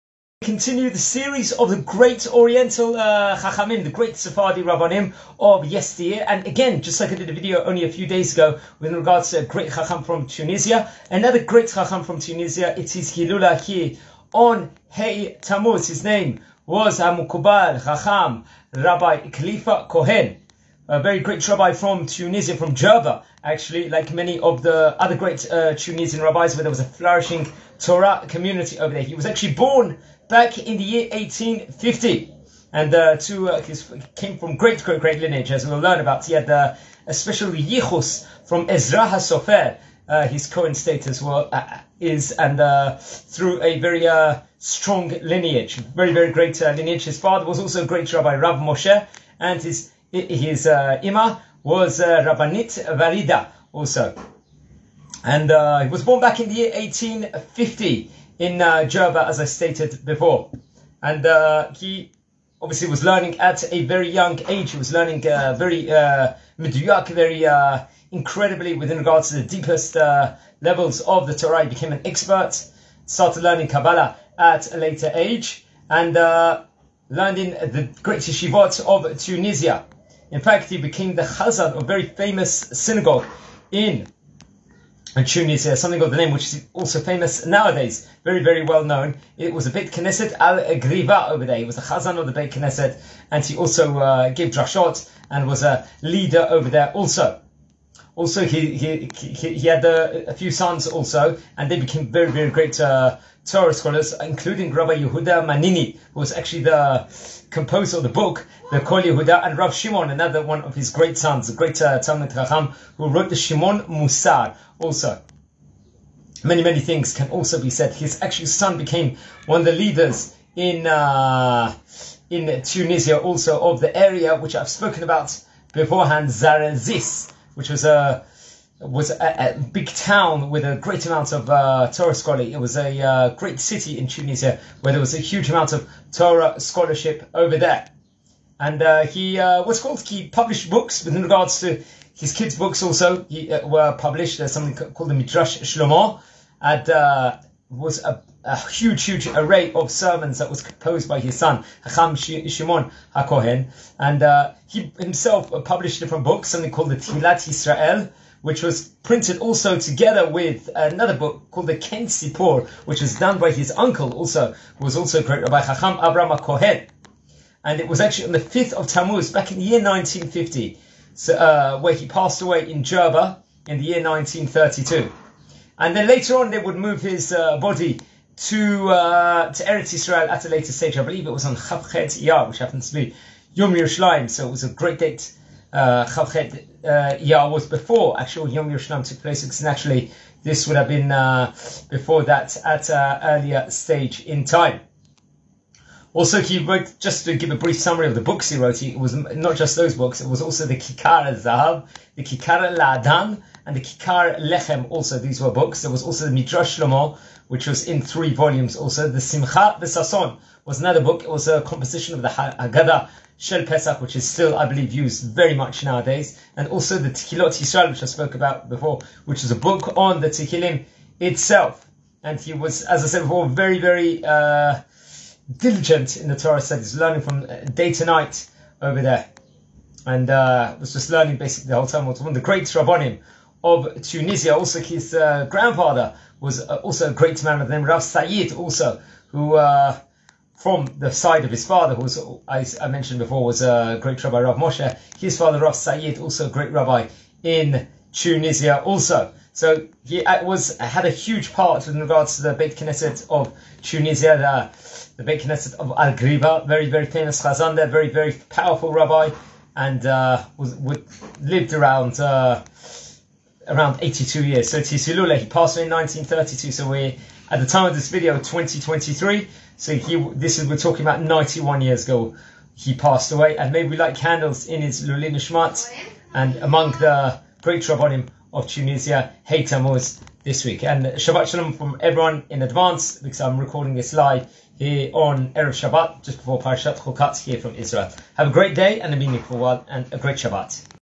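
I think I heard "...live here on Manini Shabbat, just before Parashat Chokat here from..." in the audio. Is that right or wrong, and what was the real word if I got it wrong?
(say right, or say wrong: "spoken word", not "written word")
wrong: "Erev", not "Manini".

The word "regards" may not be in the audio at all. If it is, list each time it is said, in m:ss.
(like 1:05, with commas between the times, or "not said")
0:08, 1:08, 2:21, 4:11.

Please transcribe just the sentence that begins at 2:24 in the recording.
There's something called the Midrash Shlomo.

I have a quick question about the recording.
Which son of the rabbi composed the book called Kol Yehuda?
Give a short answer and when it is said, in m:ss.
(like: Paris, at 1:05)
Rabbi Yehuda Manini, at 1:44.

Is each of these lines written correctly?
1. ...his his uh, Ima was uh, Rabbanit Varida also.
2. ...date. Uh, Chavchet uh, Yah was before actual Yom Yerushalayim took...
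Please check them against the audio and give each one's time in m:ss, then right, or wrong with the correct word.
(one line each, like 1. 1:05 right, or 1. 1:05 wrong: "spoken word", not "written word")
1. 0:49 right
2. 3:04 right.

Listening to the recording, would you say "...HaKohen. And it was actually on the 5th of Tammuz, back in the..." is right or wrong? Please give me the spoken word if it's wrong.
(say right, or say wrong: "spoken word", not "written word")
right.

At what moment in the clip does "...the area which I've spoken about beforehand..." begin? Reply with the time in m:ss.
2:03.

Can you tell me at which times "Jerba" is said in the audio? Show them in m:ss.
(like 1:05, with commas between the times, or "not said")
0:22, 0:58, 2:52.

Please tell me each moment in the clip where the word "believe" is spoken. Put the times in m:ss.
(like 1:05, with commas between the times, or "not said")
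3:01, 3:34.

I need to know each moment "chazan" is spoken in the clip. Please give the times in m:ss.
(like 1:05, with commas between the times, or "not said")
1:21, 1:31, 4:17.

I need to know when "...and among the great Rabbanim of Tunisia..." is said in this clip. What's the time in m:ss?
4:36.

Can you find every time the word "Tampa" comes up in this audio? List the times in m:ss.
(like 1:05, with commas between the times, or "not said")
not said.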